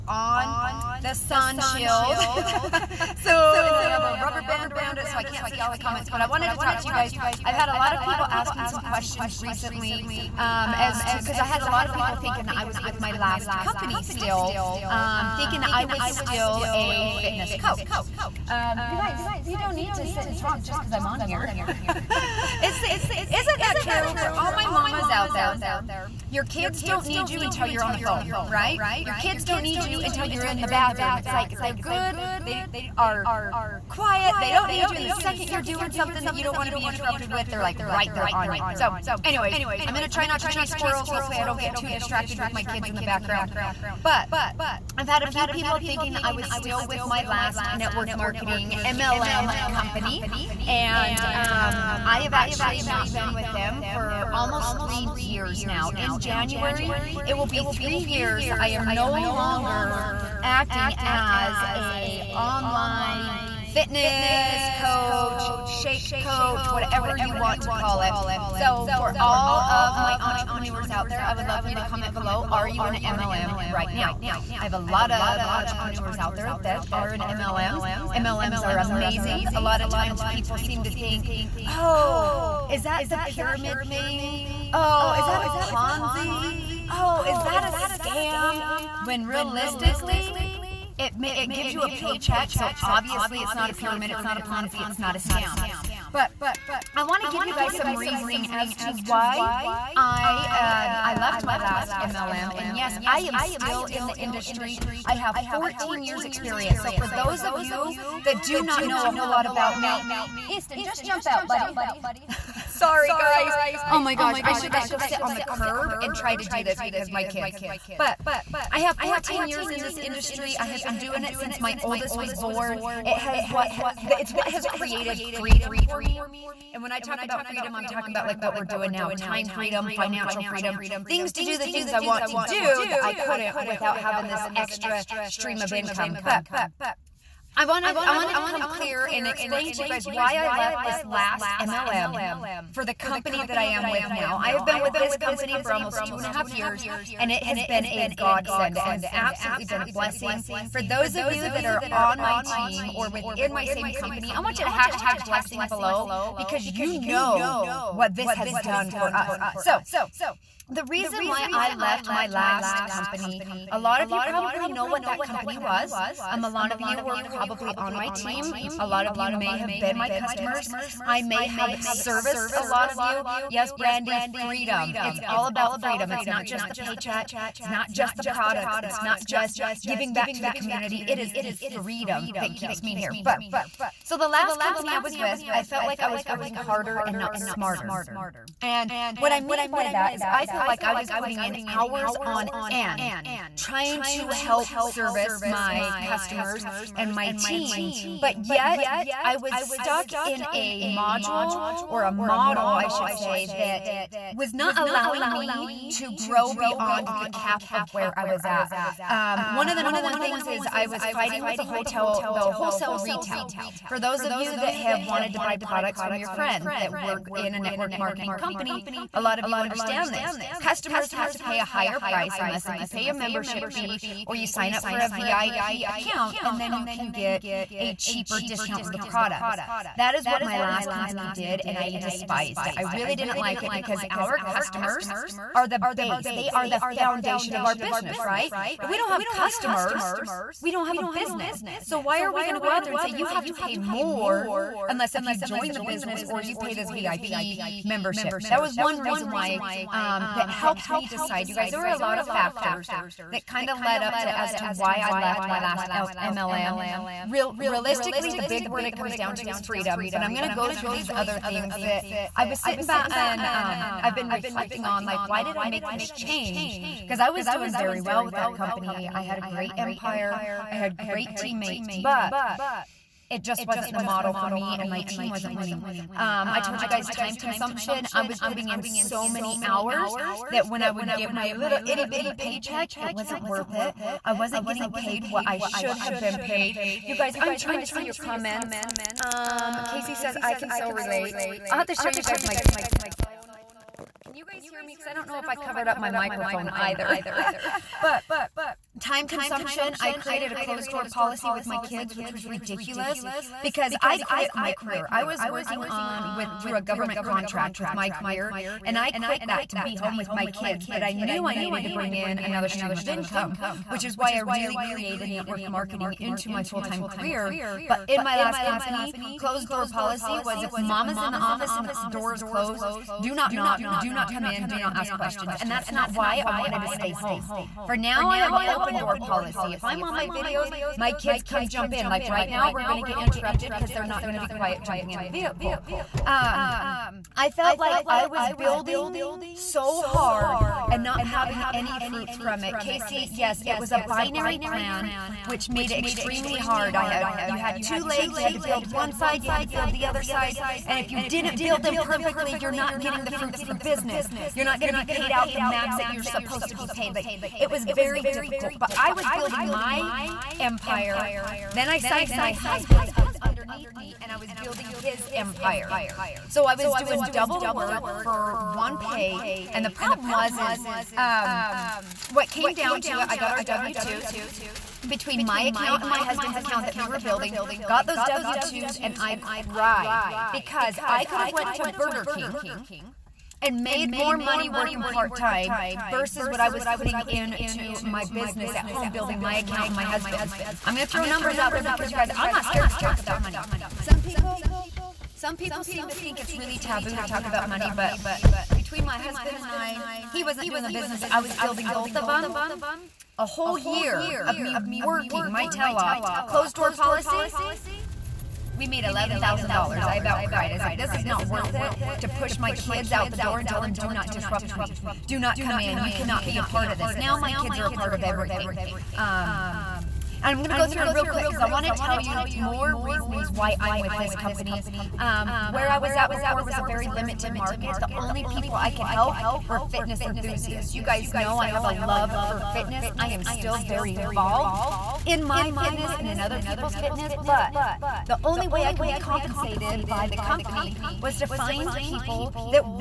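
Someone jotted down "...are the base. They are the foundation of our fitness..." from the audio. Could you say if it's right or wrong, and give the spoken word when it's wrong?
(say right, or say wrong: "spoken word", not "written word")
wrong: "business", not "fitness".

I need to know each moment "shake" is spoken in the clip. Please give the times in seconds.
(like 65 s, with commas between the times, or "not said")
65 s.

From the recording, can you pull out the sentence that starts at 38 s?
So, anyways, I'm going to try not to chase squirrels.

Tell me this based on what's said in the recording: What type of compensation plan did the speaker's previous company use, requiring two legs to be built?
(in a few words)
binary plan.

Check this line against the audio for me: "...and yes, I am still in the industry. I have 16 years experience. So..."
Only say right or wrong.
wrong.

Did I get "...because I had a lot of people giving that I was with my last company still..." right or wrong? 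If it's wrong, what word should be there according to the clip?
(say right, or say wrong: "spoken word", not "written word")
wrong: "thinking", not "giving".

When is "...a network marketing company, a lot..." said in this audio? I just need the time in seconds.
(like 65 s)
217 s.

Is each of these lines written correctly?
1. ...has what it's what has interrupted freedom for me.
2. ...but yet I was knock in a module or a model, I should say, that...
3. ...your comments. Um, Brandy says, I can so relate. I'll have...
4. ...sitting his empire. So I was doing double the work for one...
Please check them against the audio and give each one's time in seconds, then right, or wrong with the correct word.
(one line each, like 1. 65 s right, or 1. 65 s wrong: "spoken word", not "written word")
1. 123 s wrong: "created", not "interrupted"
2. 198 s wrong: "stuck", not "knock"
3. 288 s wrong: "Casey", not "Brandy"
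4. 364 s wrong: "building", not "sitting".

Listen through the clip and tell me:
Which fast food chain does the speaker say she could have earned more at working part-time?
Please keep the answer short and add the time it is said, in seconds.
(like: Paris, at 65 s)
Burger King, at 381 s.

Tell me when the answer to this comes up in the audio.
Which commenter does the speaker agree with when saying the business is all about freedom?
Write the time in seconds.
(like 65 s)
173 s.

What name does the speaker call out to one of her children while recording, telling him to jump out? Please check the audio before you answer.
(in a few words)
Easton.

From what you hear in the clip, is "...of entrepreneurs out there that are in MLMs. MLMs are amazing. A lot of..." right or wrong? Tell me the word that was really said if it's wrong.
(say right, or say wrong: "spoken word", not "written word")
right.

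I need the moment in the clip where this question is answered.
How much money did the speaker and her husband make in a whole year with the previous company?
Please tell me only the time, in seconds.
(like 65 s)
409 s.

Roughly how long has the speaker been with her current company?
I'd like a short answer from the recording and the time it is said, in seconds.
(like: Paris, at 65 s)
almost two and a half years, at 145 s.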